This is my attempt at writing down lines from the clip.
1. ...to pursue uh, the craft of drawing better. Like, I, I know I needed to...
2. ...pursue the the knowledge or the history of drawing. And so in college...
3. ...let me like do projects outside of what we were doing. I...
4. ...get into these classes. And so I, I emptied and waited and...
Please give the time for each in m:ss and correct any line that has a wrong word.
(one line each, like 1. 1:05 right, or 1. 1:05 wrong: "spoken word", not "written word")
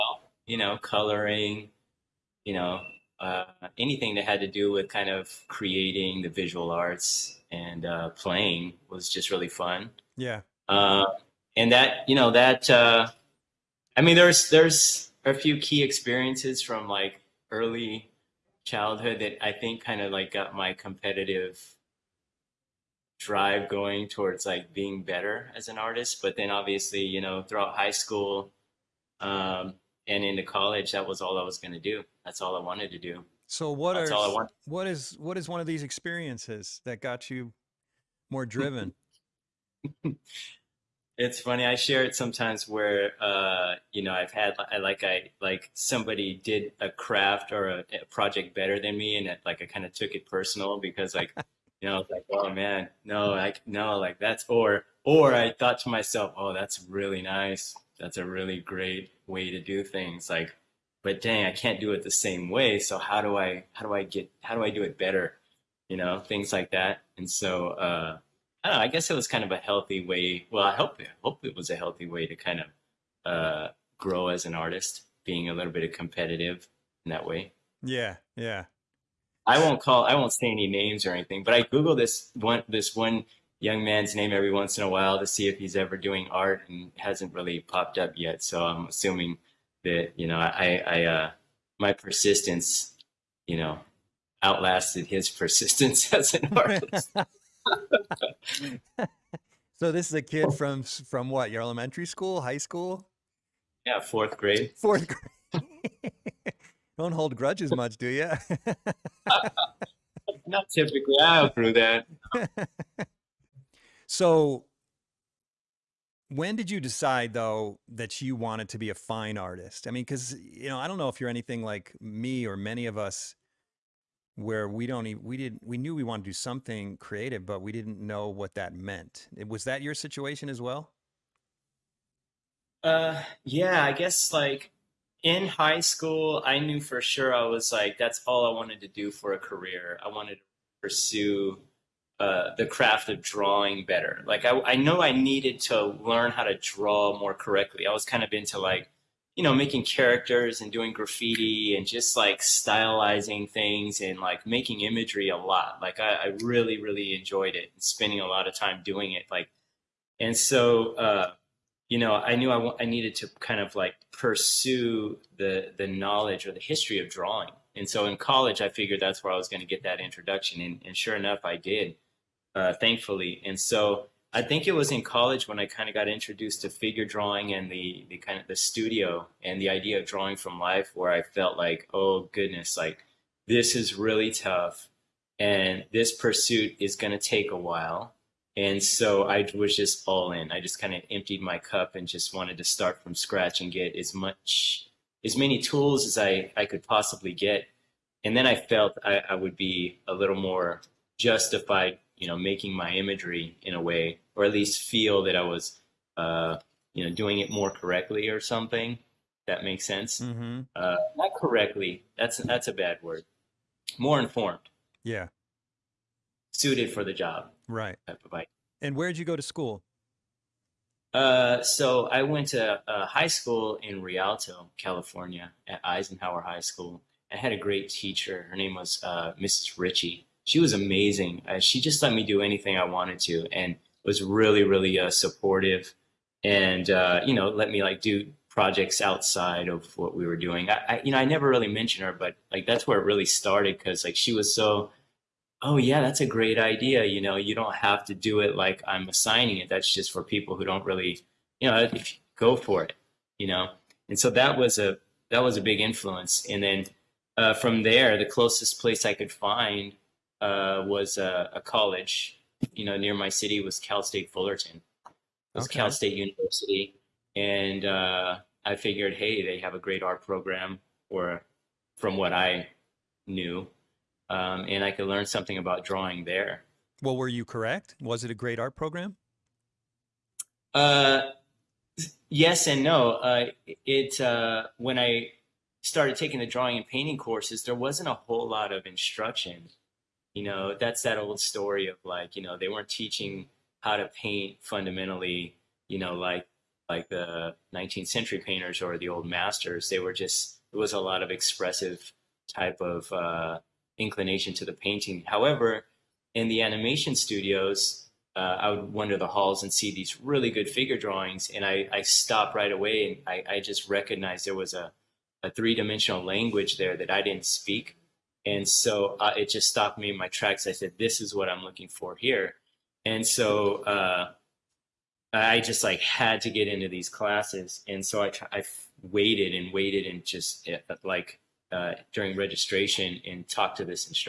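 1. 2:20 right
2. 2:44 right
3. 3:57 right
4. 5:26 wrong: "waited", not "emptied".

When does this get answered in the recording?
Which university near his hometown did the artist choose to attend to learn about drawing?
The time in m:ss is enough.
4:23.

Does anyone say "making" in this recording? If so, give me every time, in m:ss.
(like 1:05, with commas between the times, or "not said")
2:29, 2:34, 3:22.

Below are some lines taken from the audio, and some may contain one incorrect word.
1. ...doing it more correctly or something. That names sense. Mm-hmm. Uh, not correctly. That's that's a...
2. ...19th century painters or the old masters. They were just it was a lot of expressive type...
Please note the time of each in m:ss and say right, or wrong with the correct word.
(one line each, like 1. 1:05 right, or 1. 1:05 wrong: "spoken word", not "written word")
1. 3:27 wrong: "makes", not "names"
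2. 4:57 right.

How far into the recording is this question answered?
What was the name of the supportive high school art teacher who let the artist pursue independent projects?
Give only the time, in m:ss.
3:49.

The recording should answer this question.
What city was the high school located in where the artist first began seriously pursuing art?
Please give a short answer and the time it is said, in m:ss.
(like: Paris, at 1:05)
Rialto, at 3:44.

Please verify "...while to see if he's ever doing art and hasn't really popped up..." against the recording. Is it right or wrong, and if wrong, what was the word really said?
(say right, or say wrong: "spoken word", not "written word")
right.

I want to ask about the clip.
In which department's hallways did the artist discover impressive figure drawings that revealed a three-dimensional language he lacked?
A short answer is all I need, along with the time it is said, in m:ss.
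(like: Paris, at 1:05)
Animation studios, at 5:06.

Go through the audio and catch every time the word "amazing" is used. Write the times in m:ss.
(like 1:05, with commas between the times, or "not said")
3:50.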